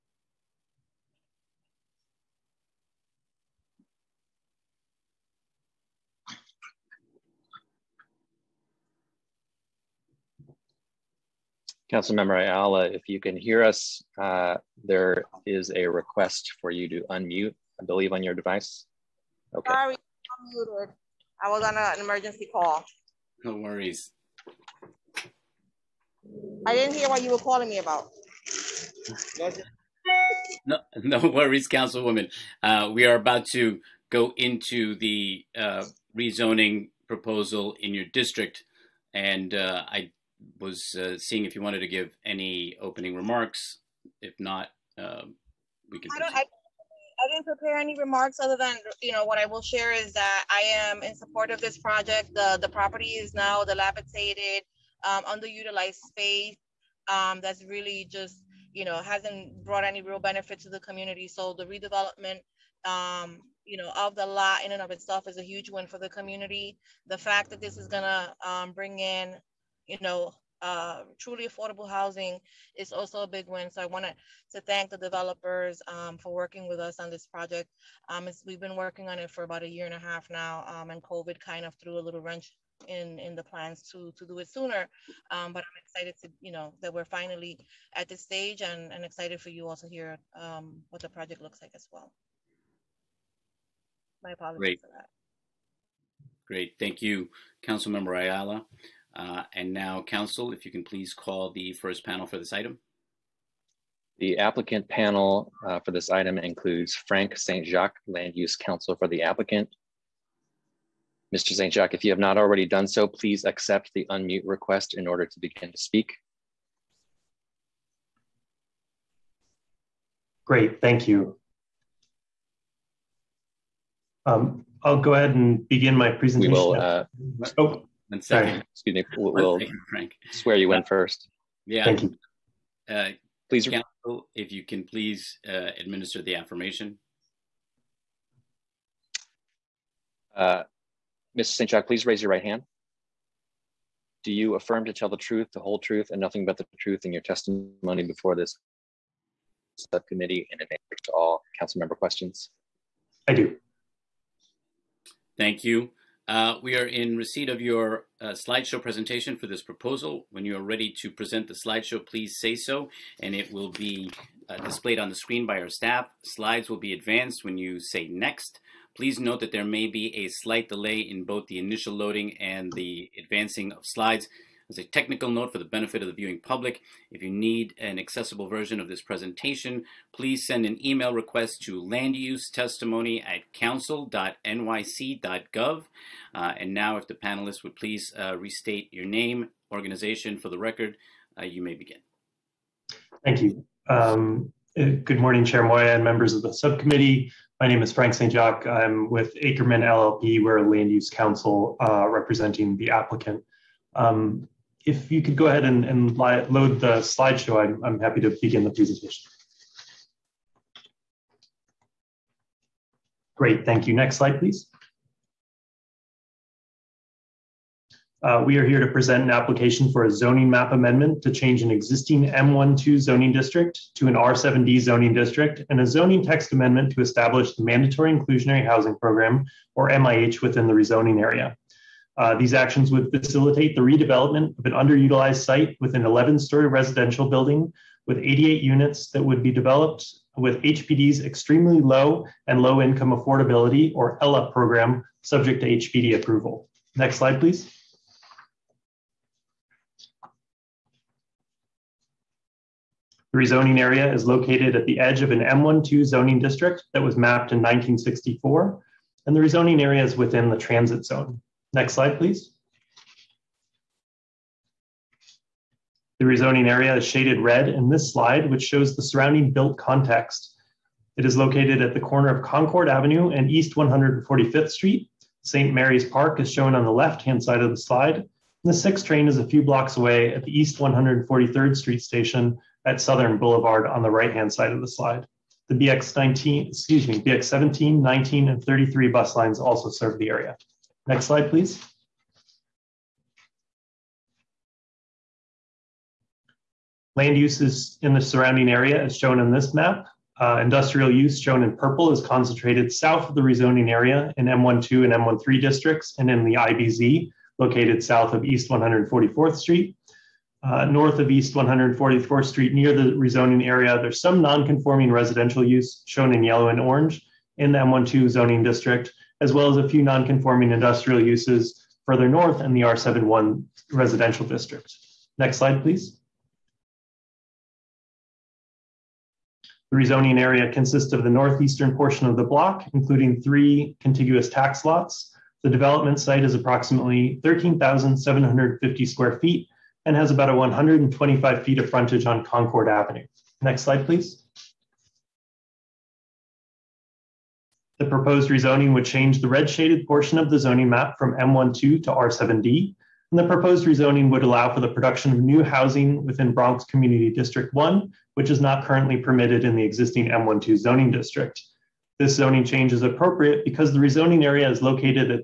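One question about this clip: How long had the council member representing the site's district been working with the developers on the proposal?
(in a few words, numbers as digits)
a year and a half.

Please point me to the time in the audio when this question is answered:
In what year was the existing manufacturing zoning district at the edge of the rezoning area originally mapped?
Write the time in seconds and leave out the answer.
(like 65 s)
257 s.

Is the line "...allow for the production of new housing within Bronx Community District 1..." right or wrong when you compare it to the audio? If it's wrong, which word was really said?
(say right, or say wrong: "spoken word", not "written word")
right.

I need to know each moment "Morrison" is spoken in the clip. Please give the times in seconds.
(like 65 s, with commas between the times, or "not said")
not said.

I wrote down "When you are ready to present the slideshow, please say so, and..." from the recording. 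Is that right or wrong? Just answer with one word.
right.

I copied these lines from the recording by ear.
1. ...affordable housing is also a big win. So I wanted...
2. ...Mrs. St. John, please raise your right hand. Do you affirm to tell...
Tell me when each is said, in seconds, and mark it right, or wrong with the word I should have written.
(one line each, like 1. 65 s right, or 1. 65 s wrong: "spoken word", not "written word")
1. 71 s right
2. 141 s right.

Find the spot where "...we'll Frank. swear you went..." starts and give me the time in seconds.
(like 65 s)
129 s.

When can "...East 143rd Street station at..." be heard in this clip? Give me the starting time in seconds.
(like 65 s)
280 s.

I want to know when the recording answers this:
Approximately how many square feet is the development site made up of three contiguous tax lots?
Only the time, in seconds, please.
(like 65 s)
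337 s.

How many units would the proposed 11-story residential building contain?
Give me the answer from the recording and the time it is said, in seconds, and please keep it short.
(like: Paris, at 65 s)
88, at 238 s.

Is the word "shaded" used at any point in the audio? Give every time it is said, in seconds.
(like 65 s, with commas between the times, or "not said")
267 s, 349 s.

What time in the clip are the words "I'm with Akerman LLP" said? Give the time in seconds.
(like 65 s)
198 s.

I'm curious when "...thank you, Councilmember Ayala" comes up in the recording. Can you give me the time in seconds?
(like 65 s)
96 s.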